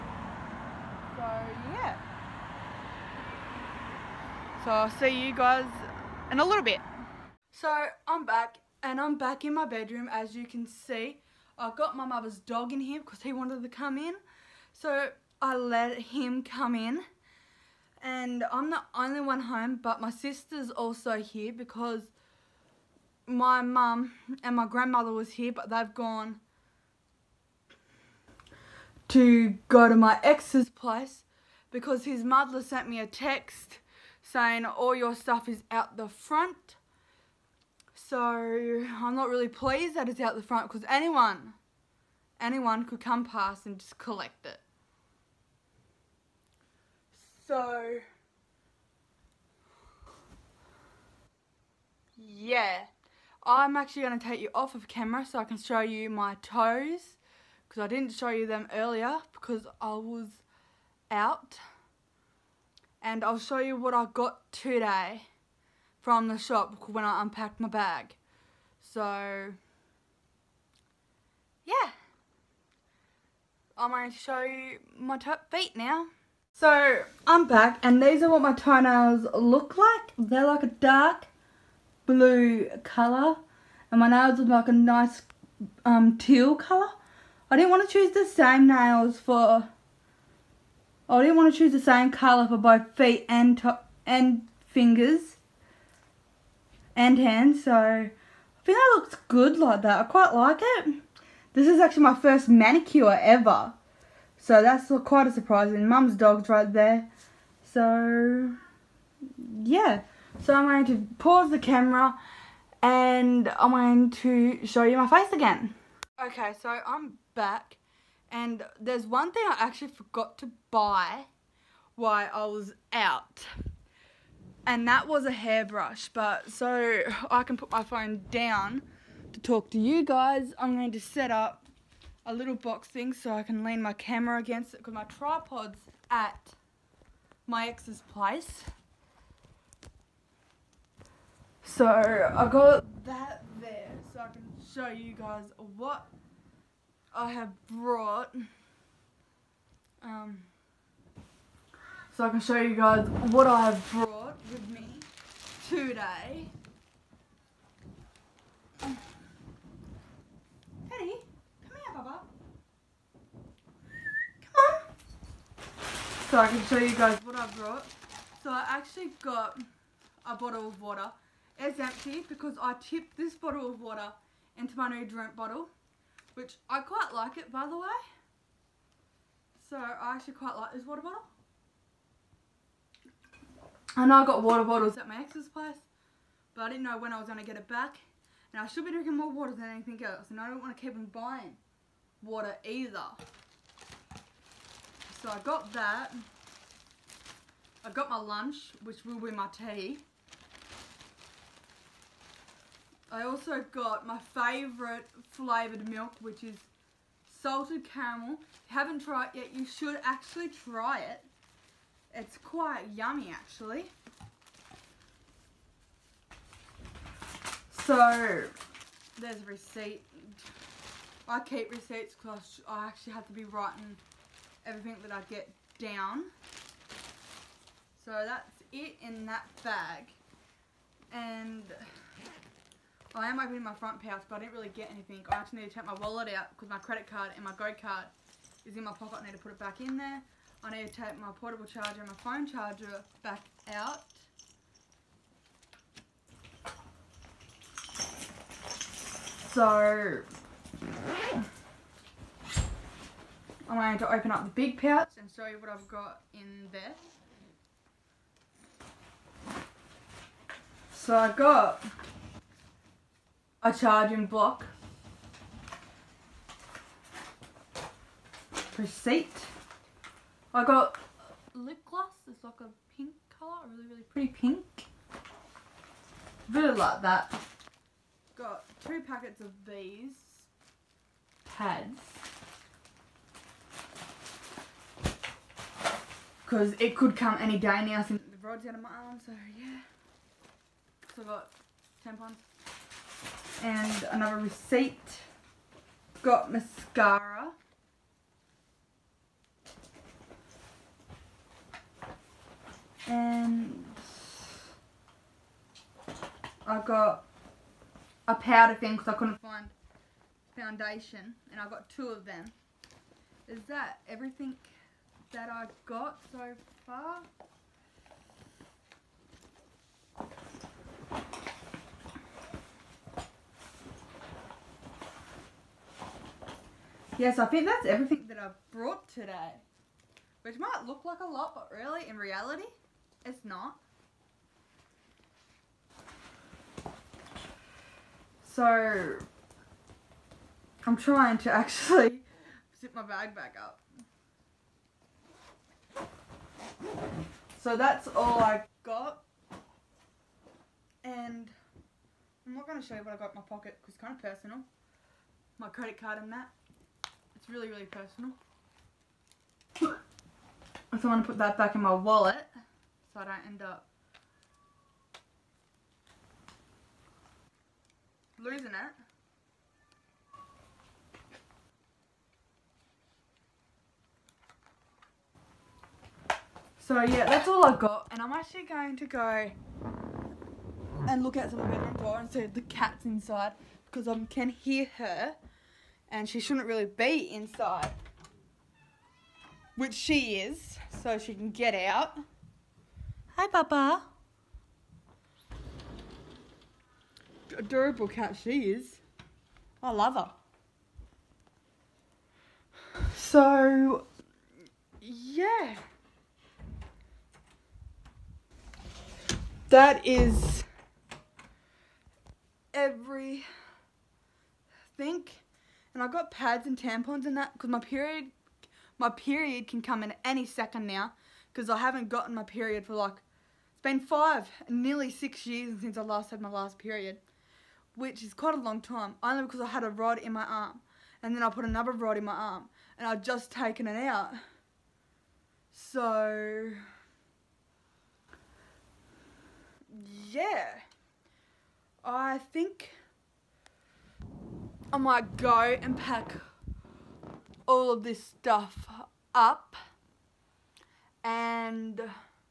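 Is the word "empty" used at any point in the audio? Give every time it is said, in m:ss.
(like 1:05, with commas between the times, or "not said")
2:51.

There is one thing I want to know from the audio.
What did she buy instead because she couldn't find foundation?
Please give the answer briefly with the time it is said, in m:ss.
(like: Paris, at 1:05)
powder, at 5:08.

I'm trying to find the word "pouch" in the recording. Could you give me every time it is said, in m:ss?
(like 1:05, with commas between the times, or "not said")
3:54, 4:14.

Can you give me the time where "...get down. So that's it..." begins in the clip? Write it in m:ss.
3:45.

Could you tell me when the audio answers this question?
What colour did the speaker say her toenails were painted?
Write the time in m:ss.
1:20.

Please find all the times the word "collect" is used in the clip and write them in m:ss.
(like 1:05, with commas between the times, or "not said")
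0:43.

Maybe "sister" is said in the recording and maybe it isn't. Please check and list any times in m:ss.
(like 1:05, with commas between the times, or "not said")
0:20.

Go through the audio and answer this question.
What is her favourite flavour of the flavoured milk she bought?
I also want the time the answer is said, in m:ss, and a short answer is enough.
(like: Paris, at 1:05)
salted caramel, at 3:27.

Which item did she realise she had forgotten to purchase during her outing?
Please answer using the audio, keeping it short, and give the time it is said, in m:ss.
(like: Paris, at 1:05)
hairbrush, at 2:05.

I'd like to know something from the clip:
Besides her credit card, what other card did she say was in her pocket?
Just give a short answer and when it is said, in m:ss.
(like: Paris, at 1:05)
Go card, at 3:57.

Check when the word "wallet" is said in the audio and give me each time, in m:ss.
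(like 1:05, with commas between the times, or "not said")
3:55, 6:01.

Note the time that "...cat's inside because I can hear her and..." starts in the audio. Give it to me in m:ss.
6:22.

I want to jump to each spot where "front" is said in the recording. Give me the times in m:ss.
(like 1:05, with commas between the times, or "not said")
0:36, 0:40, 3:53.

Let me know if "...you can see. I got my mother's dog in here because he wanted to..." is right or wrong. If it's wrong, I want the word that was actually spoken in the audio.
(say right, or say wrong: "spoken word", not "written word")
right.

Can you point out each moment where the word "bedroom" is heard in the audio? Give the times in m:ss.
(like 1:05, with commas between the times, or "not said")
0:09, 6:21.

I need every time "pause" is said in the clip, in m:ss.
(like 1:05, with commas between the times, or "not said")
1:51.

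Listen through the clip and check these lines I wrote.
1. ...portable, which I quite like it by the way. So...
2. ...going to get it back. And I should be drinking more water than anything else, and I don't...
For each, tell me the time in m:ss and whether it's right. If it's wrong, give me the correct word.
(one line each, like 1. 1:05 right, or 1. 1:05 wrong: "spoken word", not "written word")
1. 2:55 wrong: "bottle", not "portable"
2. 3:07 right.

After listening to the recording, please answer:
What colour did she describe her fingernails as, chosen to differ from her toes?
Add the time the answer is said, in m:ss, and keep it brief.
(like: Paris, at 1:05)
teal, at 1:26.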